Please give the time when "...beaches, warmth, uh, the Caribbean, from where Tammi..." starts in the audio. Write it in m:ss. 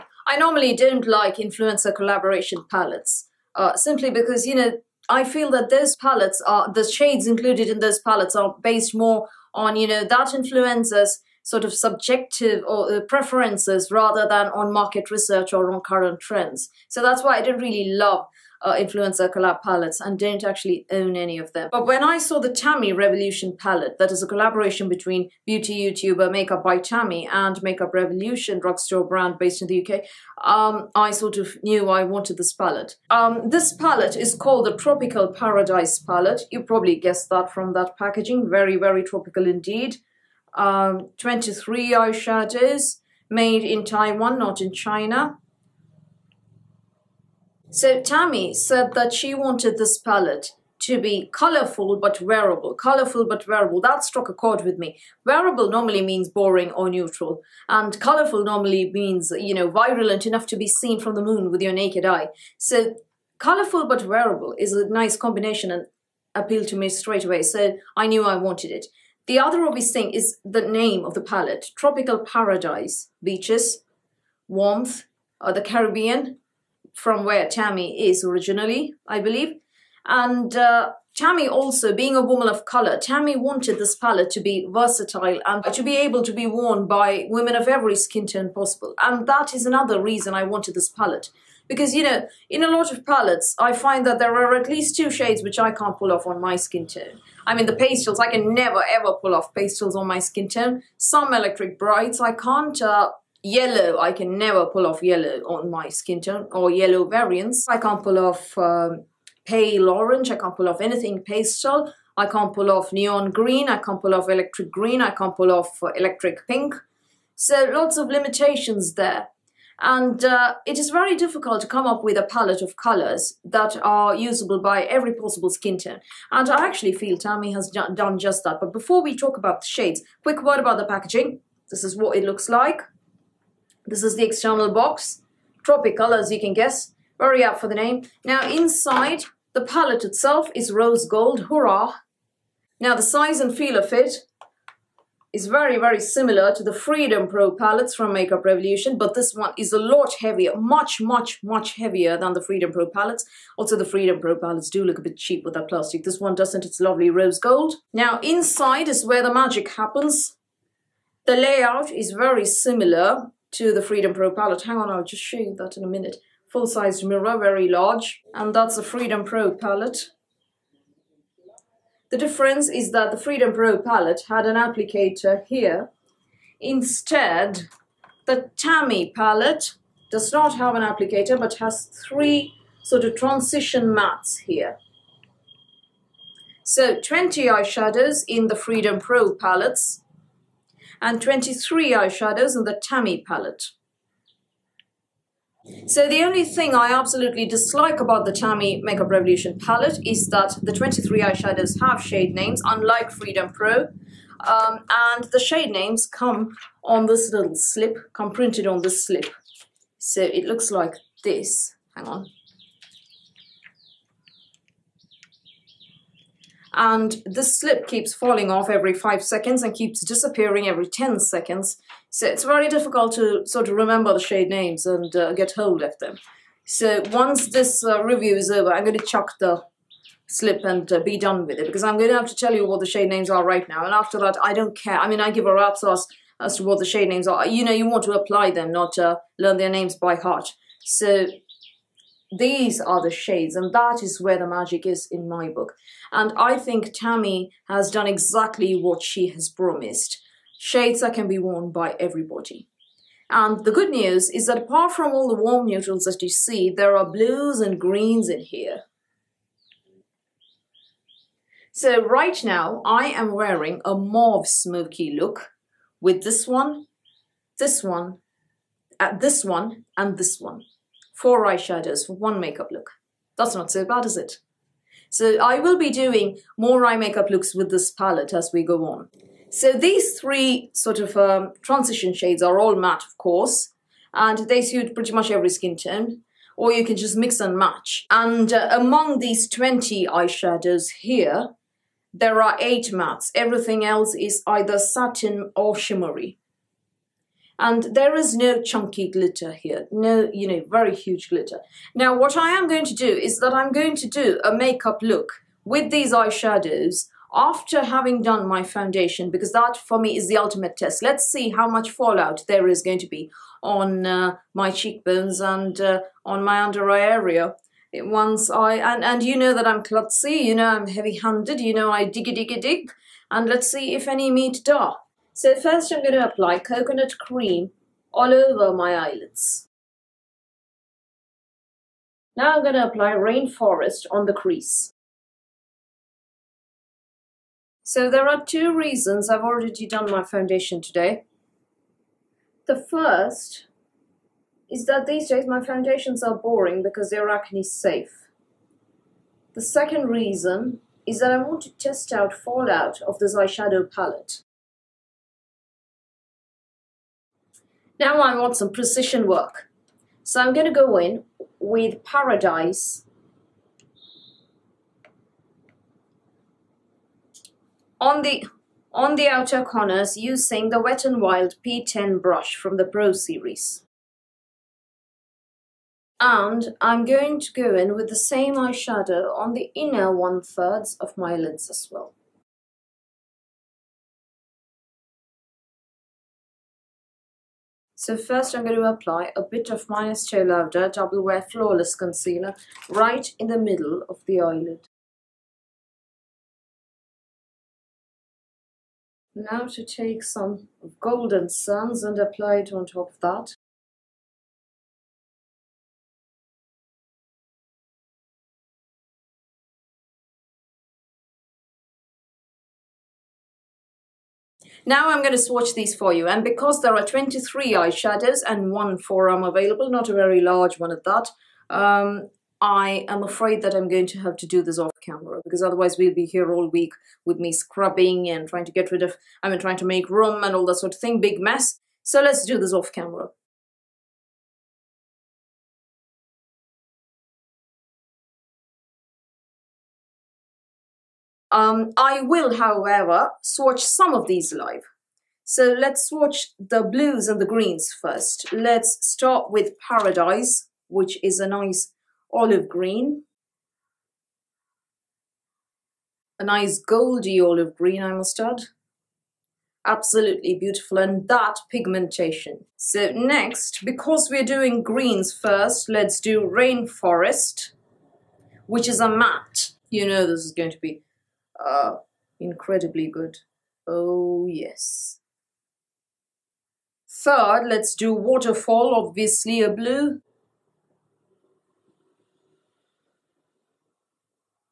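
1:13.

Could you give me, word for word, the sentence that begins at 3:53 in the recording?
And after that, I don't care.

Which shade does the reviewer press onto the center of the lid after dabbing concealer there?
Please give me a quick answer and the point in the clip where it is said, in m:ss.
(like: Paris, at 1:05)
Golden Suns, at 6:40.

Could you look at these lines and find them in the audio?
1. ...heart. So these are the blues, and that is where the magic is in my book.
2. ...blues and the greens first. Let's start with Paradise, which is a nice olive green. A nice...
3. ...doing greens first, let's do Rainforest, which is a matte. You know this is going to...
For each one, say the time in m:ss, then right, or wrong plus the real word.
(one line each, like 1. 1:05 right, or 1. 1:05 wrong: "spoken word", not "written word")
1. 4:00 wrong: "shades", not "blues"
2. 7:26 right
3. 7:44 right.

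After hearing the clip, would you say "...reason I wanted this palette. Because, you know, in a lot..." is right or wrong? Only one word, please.
right.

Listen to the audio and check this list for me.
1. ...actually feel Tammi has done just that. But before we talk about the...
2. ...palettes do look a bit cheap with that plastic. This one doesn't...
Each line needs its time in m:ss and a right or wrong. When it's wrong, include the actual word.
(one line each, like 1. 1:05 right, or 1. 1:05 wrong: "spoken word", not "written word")
1. 2:06 right
2. 2:34 right.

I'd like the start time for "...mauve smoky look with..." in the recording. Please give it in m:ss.
4:23.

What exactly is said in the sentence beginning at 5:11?
Let's see how much fallout there is going to be on uh, my cheekbones and uh, on my under eye area.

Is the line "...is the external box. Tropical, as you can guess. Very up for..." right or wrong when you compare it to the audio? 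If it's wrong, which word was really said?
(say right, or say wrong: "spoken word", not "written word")
right.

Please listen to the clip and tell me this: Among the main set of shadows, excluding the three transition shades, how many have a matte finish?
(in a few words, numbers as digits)
8.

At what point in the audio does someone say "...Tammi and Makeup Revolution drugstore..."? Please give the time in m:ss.
0:26.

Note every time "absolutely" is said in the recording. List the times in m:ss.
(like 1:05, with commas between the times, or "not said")
3:16, 7:39.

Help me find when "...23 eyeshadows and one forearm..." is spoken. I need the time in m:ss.
6:57.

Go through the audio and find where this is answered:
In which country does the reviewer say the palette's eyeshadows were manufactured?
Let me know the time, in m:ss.
0:43.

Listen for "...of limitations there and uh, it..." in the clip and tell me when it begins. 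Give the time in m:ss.
1:57.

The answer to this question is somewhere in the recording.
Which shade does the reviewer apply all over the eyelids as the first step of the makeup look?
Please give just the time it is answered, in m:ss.
5:26.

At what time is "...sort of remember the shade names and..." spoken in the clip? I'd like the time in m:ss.
3:43.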